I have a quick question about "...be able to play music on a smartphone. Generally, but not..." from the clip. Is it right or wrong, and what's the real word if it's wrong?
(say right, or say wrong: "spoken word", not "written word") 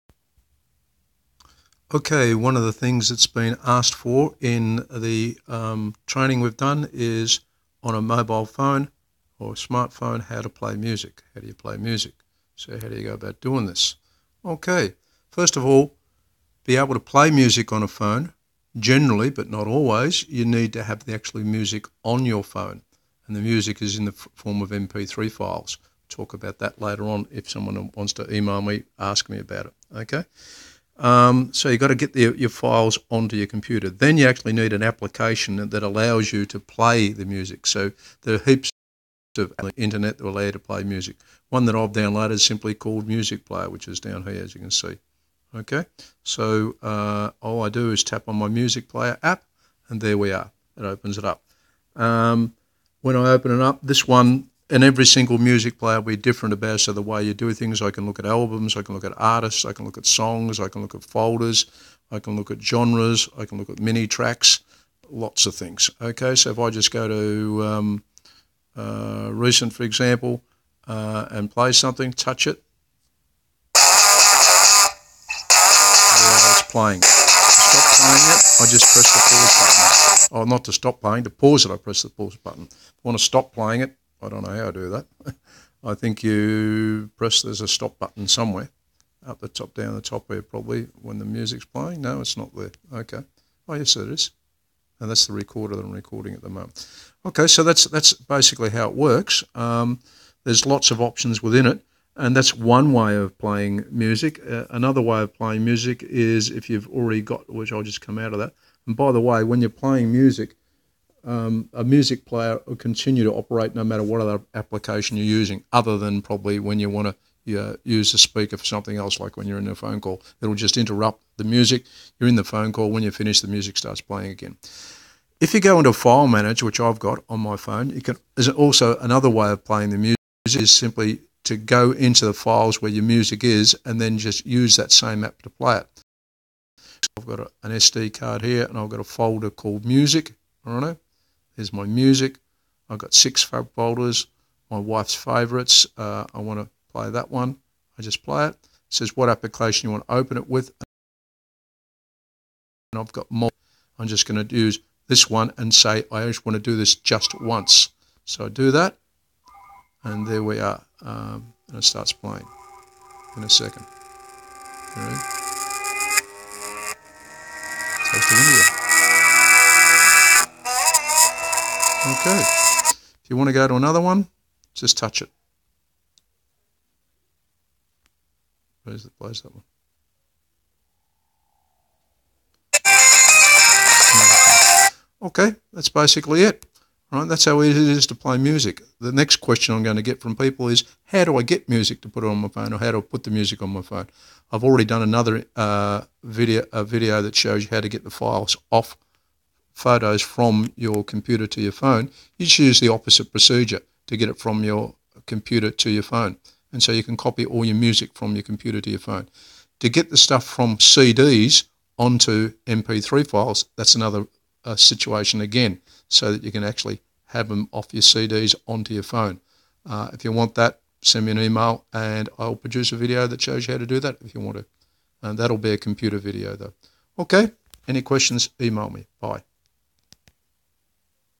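wrong: "phone", not "smartphone".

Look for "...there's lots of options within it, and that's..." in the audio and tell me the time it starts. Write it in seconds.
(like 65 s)
100 s.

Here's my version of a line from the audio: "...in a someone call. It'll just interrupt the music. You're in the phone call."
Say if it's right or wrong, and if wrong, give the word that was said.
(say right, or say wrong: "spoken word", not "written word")
wrong: "phone", not "someone".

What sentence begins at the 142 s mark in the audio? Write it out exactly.
I've got six fab folders, my wife's favorites.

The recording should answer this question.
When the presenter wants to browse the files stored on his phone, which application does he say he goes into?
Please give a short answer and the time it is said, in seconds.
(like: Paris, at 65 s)
File Manager, at 125 s.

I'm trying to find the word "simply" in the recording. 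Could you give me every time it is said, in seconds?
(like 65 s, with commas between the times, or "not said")
42 s, 130 s.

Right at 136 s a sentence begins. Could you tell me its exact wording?
So I've got a, an SD card here and I've got a folder called music.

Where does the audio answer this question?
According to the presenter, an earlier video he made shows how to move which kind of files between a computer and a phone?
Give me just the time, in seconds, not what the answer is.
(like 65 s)
199 s.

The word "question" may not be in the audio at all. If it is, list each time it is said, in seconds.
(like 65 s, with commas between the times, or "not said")
189 s, 228 s.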